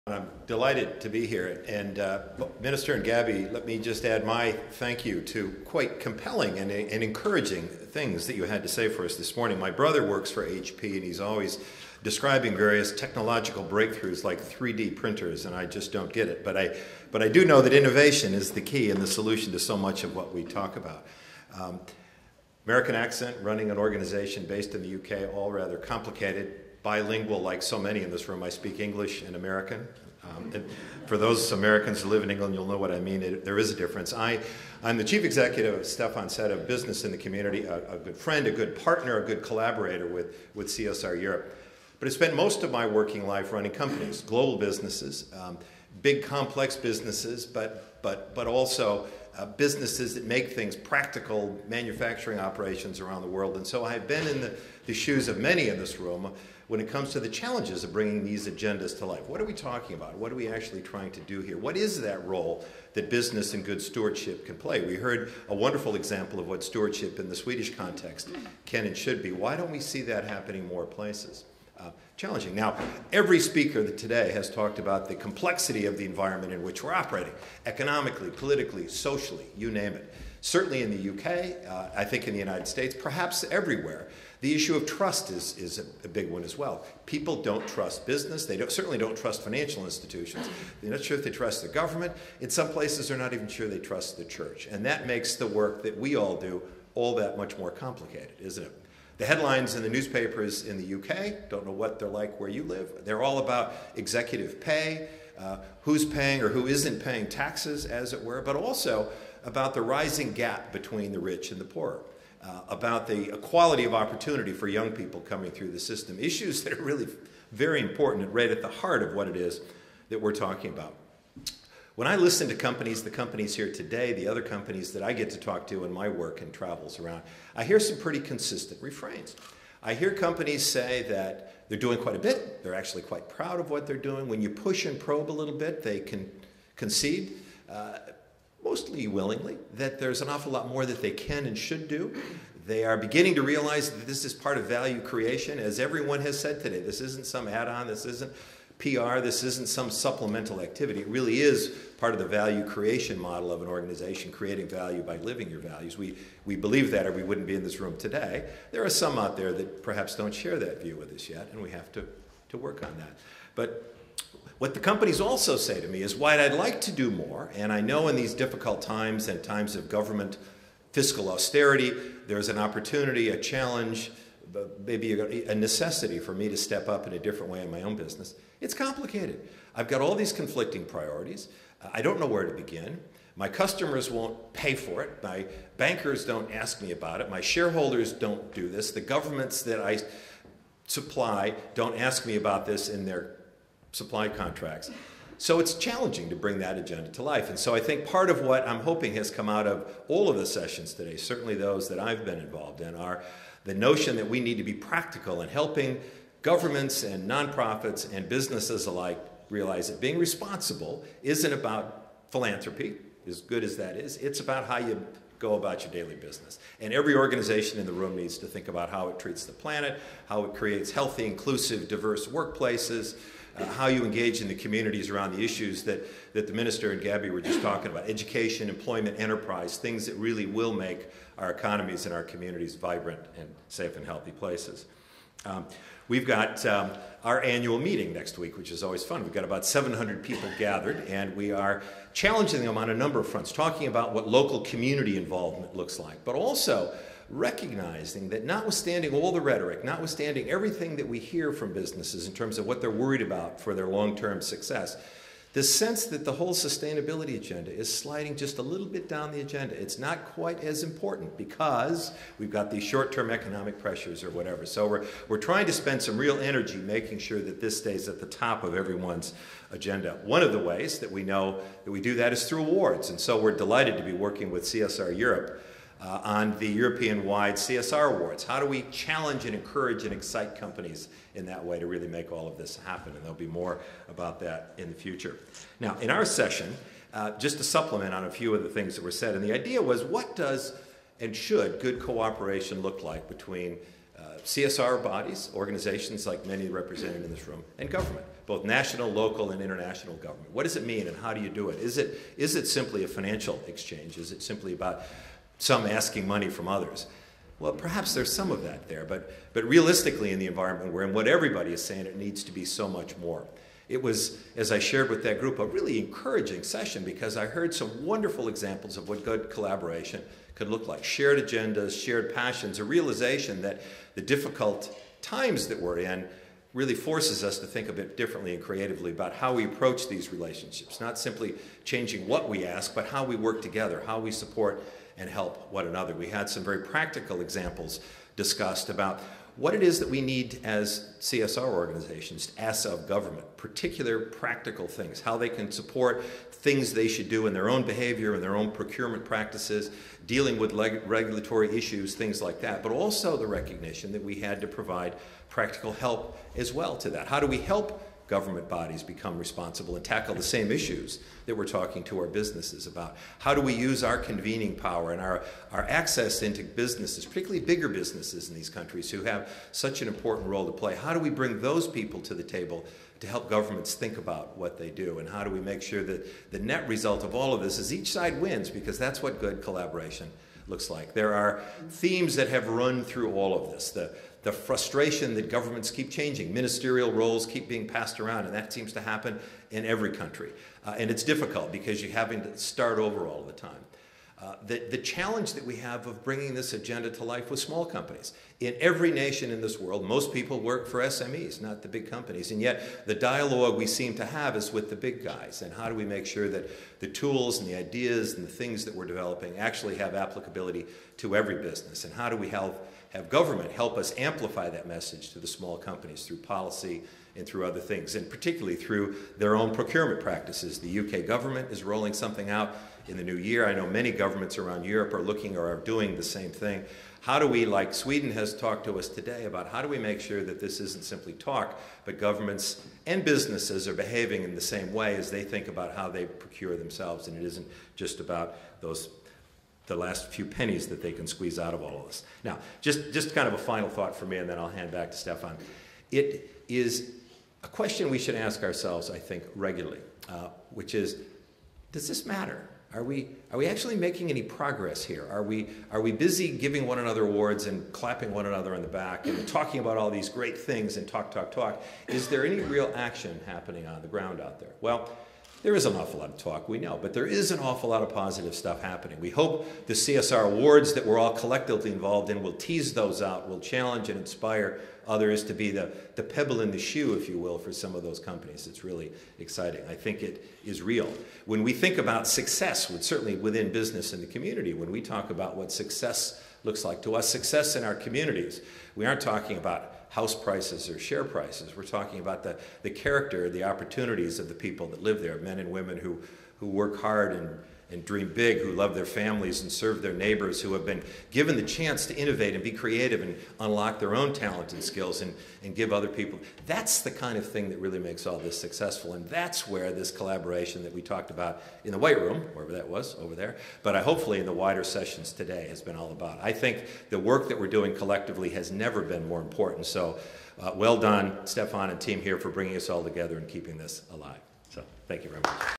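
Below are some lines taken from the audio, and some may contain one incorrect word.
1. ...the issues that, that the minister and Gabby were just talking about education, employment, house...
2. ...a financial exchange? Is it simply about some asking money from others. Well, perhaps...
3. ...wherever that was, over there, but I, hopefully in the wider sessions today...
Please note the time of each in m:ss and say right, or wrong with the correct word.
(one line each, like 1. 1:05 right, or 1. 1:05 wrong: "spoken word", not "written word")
1. 3:45 wrong: "enterprise", not "house"
2. 5:03 right
3. 8:32 right.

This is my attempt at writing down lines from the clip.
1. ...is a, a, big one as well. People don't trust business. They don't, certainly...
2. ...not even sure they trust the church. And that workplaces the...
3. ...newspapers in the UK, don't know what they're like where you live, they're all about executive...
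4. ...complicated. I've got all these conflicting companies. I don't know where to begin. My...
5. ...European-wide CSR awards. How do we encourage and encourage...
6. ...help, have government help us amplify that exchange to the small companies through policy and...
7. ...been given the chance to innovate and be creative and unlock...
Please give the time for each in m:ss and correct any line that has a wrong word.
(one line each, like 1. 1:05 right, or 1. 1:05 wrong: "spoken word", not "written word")
1. 1:25 right
2. 1:33 wrong: "makes", not "workplaces"
3. 1:39 right
4. 2:58 wrong: "priorities", not "companies"
5. 4:36 wrong: "challenge", not "encourage"
6. 6:52 wrong: "message", not "exchange"
7. 8:20 right.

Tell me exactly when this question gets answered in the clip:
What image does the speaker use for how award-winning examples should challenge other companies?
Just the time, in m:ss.
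7:56.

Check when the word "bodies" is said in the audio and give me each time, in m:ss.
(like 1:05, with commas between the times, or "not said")
4:55, 5:58.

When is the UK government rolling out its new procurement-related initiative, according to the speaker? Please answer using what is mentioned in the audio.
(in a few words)
in the new year.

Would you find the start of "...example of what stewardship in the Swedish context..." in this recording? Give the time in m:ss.
1:05.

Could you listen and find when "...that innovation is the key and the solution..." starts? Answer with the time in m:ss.
0:17.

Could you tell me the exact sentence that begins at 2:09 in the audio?
I hear companies say that they're doing quite a bit, they're actually quite proud of what they're doing.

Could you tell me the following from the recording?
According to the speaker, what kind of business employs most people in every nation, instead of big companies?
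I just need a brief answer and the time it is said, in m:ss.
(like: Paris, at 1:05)
SMEs, at 6:41.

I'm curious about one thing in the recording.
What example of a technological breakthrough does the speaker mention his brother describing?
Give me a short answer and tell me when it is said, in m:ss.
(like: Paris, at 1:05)
3D printers, at 0:14.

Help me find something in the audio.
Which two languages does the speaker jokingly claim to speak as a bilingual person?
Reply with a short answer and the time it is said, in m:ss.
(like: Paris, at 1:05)
English and American, at 0:28.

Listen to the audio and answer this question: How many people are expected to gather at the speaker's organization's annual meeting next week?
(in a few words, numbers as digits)
700.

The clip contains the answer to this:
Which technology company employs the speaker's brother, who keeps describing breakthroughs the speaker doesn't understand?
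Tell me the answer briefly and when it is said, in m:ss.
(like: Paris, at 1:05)
HP, at 0:10.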